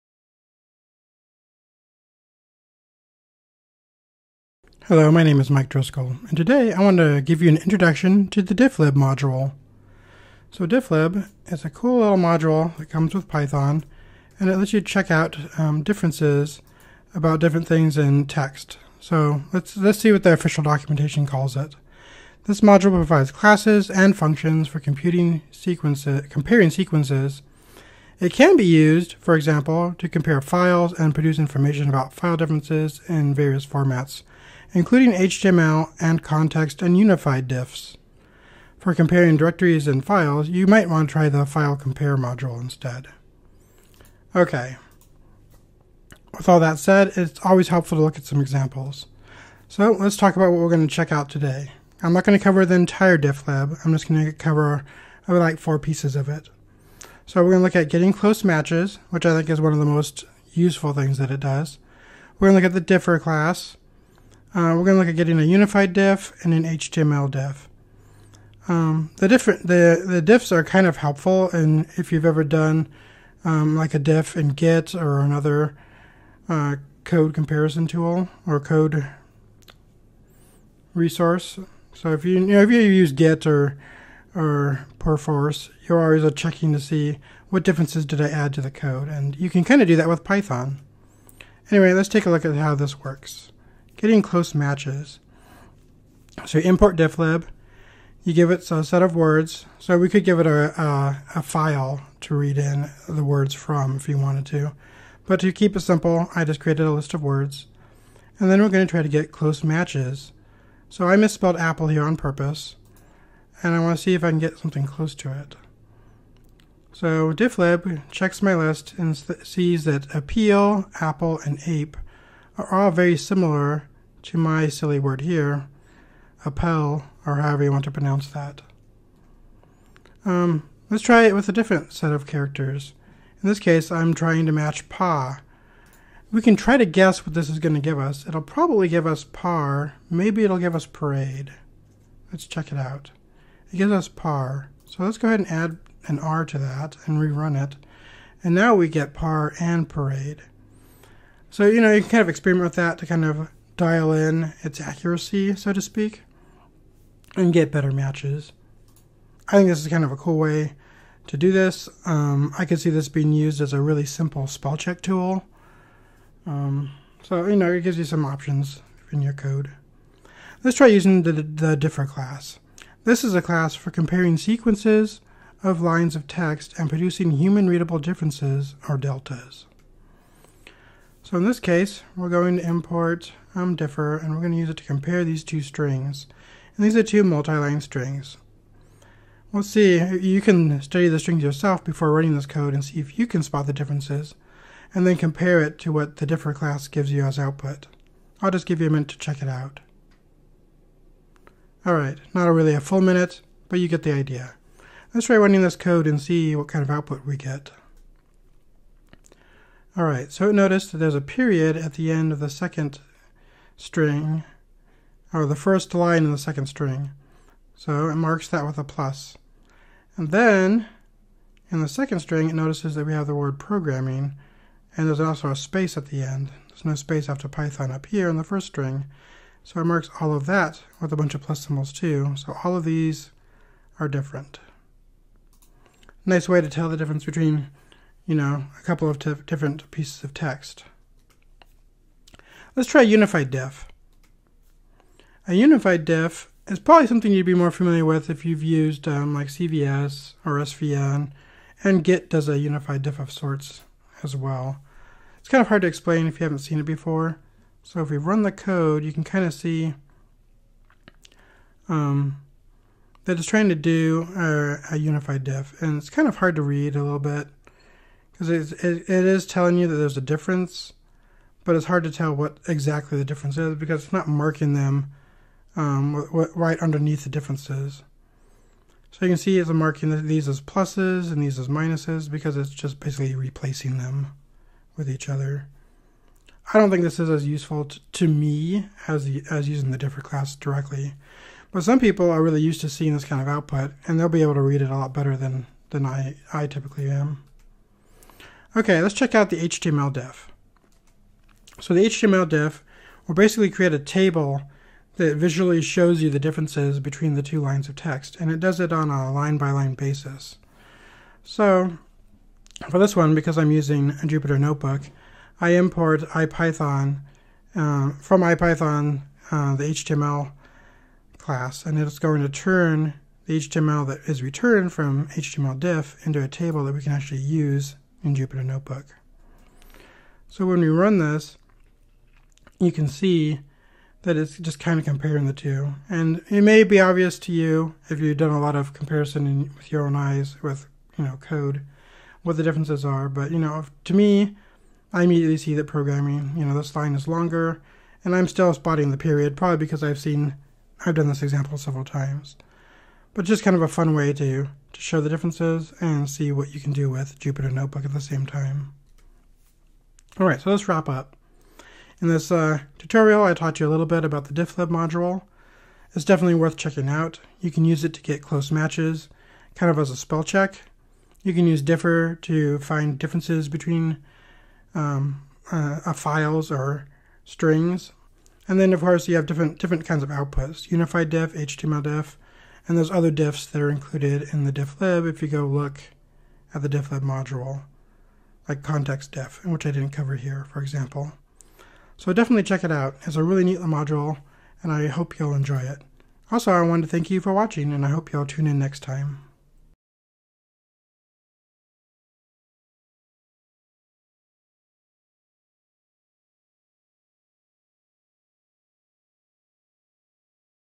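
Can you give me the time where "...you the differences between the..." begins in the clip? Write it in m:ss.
5:06.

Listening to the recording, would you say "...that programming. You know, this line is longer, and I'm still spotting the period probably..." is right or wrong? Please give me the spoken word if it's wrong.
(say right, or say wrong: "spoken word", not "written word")
right.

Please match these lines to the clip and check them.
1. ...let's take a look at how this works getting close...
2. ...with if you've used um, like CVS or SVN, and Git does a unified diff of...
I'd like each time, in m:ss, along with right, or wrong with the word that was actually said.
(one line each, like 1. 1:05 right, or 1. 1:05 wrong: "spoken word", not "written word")
1. 1:31 right
2. 4:08 right.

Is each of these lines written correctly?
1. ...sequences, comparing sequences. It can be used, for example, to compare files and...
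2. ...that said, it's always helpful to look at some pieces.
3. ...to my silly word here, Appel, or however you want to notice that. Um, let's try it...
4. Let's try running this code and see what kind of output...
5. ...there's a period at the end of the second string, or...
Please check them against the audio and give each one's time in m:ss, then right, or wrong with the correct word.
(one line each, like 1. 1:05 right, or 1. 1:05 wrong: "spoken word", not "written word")
1. 0:25 right
2. 0:46 wrong: "examples", not "pieces"
3. 2:04 wrong: "pronounce", not "notice"
4. 3:25 right
5. 3:30 right.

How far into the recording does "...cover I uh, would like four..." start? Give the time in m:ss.
0:54.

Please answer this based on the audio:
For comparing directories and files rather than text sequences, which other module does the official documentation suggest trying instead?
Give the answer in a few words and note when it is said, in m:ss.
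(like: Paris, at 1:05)
File Compare module, at 0:41.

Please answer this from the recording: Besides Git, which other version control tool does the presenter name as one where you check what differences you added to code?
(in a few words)
Perforce.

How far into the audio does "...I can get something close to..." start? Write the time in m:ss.
1:54.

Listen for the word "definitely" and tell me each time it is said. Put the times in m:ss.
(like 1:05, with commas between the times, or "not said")
6:06, 6:32.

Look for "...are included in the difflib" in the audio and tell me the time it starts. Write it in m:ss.
6:23.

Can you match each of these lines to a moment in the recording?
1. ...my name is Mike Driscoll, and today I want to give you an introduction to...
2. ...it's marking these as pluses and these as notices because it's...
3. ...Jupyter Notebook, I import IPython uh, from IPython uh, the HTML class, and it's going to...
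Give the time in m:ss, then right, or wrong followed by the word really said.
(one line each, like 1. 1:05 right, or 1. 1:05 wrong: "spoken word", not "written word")
1. 0:05 right
2. 4:39 wrong: "minuses", not "notices"
3. 5:14 right.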